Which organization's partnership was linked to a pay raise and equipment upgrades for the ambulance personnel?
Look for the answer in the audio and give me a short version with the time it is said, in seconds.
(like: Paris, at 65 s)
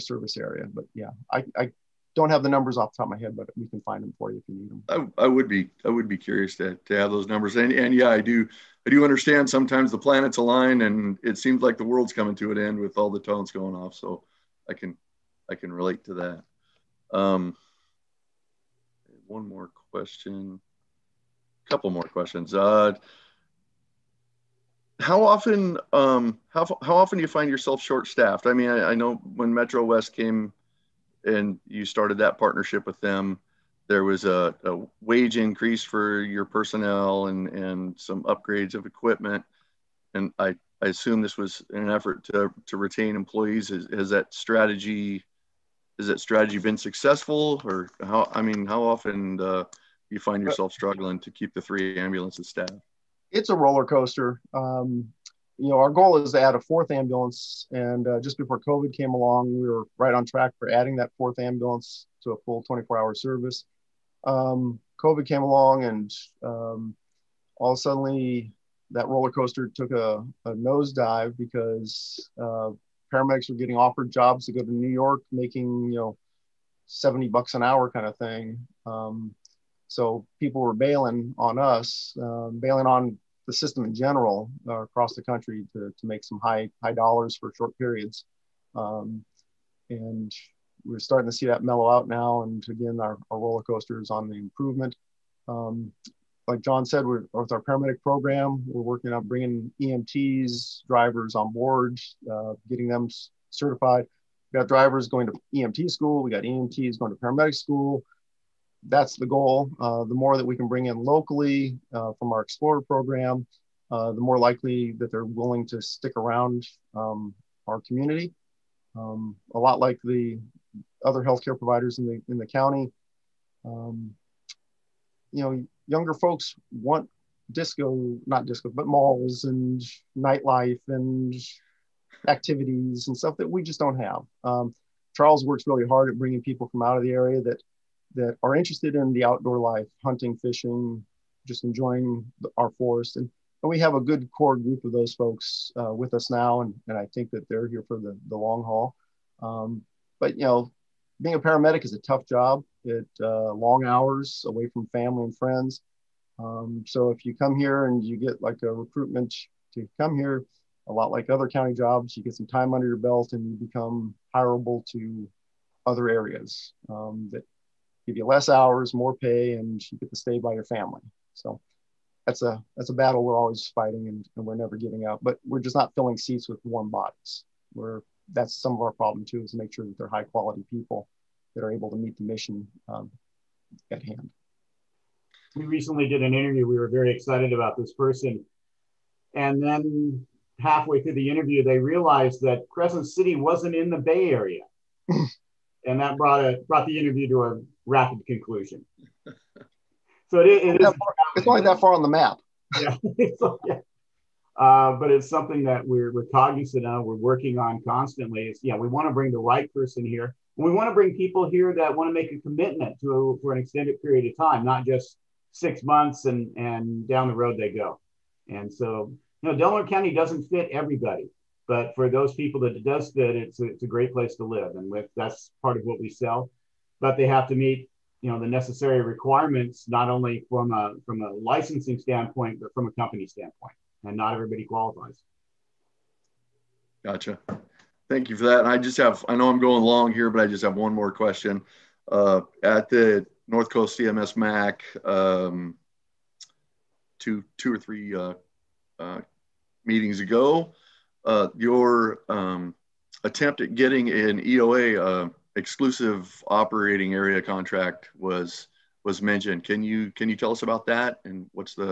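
Metro West, at 29 s.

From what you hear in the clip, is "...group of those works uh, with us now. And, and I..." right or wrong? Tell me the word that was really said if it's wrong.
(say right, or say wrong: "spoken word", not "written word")
wrong: "folks", not "works".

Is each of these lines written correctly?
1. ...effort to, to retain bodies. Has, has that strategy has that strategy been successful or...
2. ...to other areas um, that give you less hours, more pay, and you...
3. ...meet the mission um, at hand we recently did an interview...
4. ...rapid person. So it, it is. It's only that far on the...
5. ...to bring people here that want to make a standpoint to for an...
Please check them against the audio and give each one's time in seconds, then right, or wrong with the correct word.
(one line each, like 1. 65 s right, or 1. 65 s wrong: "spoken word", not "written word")
1. 41 s wrong: "employees", not "bodies"
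2. 164 s right
3. 181 s right
4. 197 s wrong: "conclusion", not "person"
5. 210 s wrong: "commitment", not "standpoint".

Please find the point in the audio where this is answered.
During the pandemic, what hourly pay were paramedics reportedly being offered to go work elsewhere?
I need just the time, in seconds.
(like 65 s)
76 s.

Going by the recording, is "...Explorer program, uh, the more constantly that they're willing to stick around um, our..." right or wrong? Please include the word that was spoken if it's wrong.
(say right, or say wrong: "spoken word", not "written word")
wrong: "likely", not "constantly".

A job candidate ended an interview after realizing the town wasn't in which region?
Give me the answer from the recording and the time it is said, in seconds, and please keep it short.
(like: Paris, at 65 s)
the Bay Area, at 193 s.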